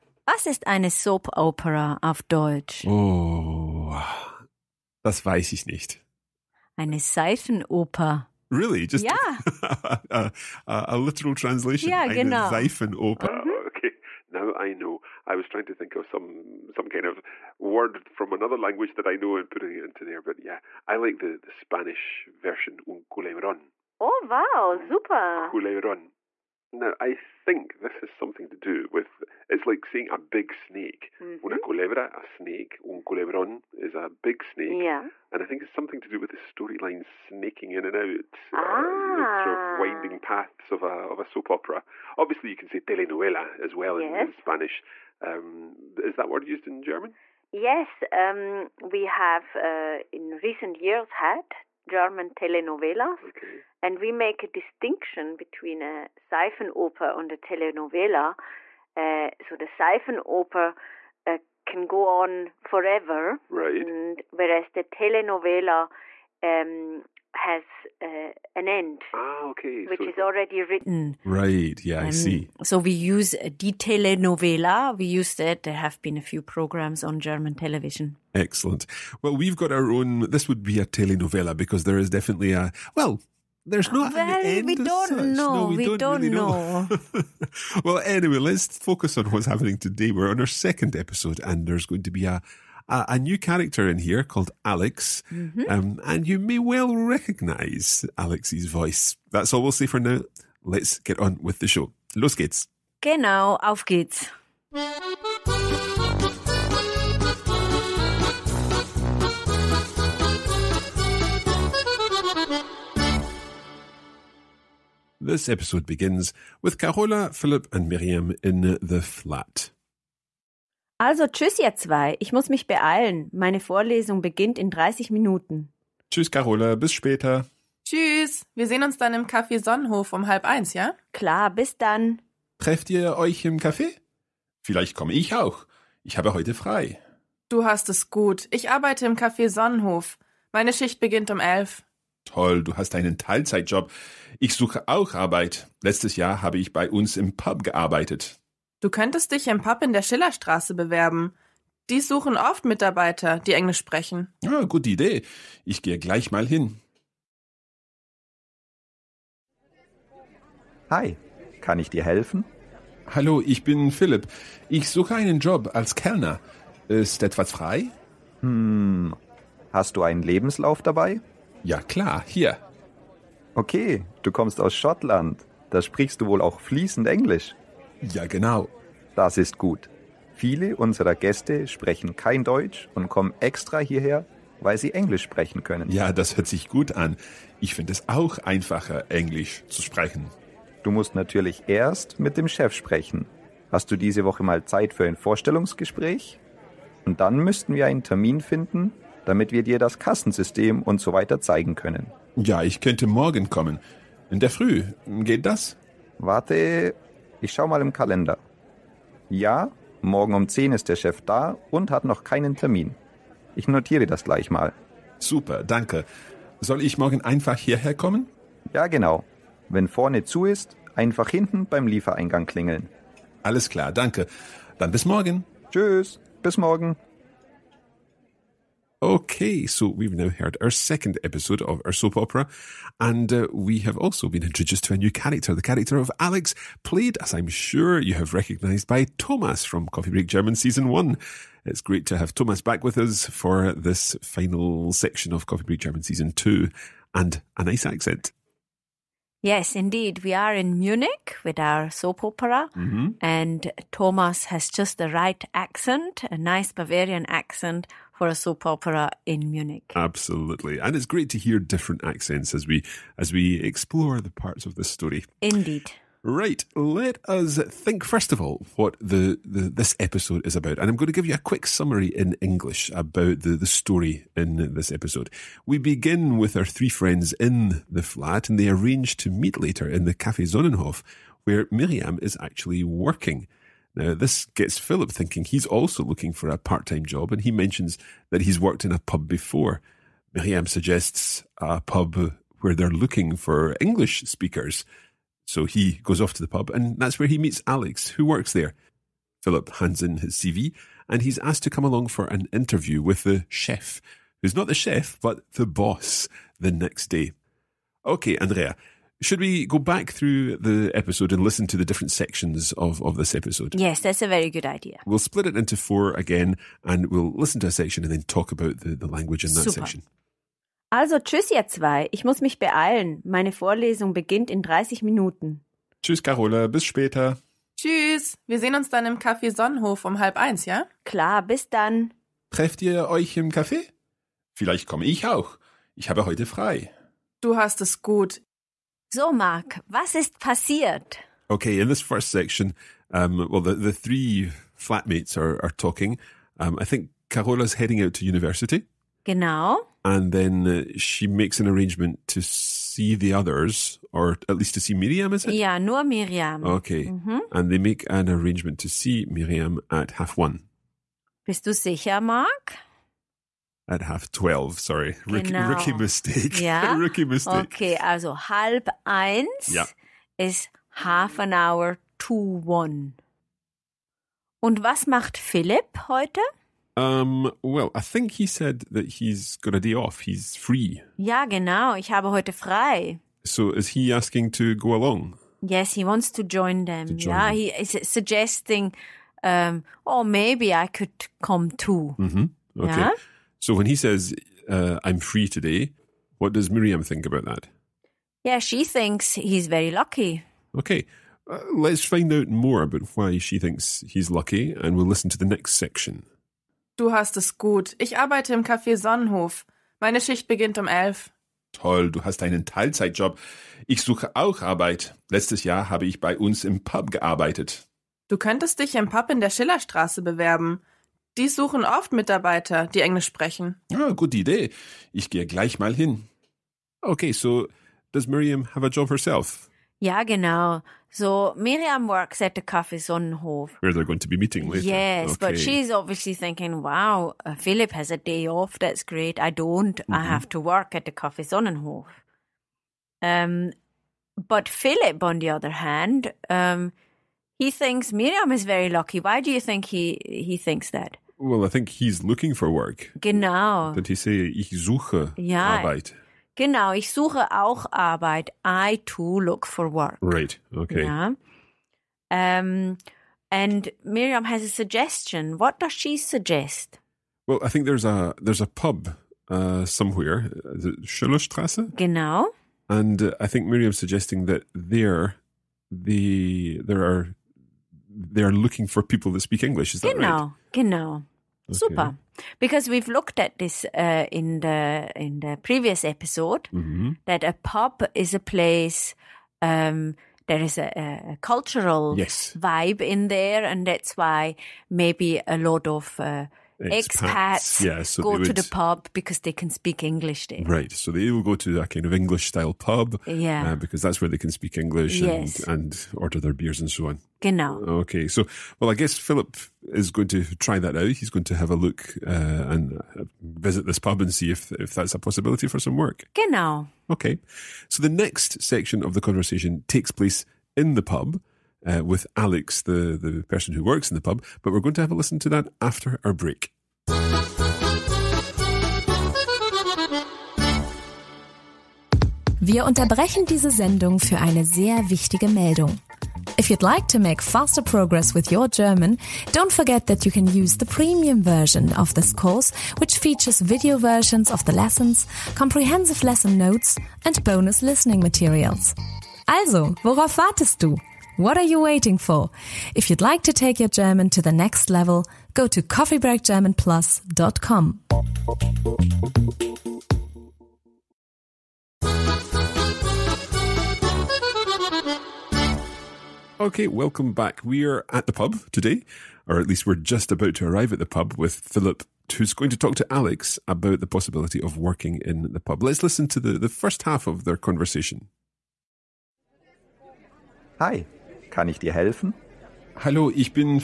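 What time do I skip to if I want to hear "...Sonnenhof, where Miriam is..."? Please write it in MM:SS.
04:40.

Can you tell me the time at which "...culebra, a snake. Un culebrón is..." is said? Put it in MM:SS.
00:31.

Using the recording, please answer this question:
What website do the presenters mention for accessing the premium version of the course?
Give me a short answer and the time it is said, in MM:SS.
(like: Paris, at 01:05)
coffeebreakgermanplus.com, at 09:15.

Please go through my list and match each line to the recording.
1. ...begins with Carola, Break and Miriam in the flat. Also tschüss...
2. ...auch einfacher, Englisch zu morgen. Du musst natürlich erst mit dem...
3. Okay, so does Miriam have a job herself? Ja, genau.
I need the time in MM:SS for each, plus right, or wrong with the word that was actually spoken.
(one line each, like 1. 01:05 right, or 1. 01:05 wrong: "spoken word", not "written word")
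1. 01:55 wrong: "Philipp", not "Break"
2. 03:08 wrong: "sprechen", not "morgen"
3. 07:06 right.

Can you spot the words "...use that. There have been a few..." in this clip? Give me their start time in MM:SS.
01:15.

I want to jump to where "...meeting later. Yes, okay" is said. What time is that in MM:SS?
07:14.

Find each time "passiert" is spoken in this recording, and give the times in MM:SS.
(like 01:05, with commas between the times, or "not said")
05:40.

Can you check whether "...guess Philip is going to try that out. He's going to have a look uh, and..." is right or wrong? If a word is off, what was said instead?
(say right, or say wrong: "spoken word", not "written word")
right.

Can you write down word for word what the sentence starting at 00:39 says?
winding paths of a, of a soap opera.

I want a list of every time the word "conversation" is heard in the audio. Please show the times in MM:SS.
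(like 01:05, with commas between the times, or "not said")
08:39, 09:37.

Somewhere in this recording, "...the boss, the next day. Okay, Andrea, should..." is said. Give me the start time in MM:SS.
05:05.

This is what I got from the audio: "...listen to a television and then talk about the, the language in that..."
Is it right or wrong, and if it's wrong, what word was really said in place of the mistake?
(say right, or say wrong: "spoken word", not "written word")
wrong: "section", not "television".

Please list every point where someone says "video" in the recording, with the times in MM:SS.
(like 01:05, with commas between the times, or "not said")
09:03.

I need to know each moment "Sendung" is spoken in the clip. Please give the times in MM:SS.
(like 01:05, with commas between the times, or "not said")
08:53.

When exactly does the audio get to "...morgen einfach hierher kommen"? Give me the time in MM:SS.
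03:36.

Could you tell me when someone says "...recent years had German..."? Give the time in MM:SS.
00:50.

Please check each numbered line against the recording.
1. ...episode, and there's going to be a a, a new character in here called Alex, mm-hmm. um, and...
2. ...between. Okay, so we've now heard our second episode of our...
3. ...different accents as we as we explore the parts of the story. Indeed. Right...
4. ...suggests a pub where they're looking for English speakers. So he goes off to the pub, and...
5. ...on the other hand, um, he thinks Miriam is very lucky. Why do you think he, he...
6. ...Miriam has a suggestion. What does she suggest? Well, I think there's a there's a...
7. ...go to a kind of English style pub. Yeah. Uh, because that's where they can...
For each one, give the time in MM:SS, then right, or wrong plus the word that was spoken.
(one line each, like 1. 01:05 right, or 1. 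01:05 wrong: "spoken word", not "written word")
1. 01:30 right
2. 03:46 wrong: "morgen", not "between"
3. 04:21 right
4. 04:50 right
5. 07:25 right
6. 07:44 right
7. 08:21 right.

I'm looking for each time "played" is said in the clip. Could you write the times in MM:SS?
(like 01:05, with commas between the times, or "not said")
03:56.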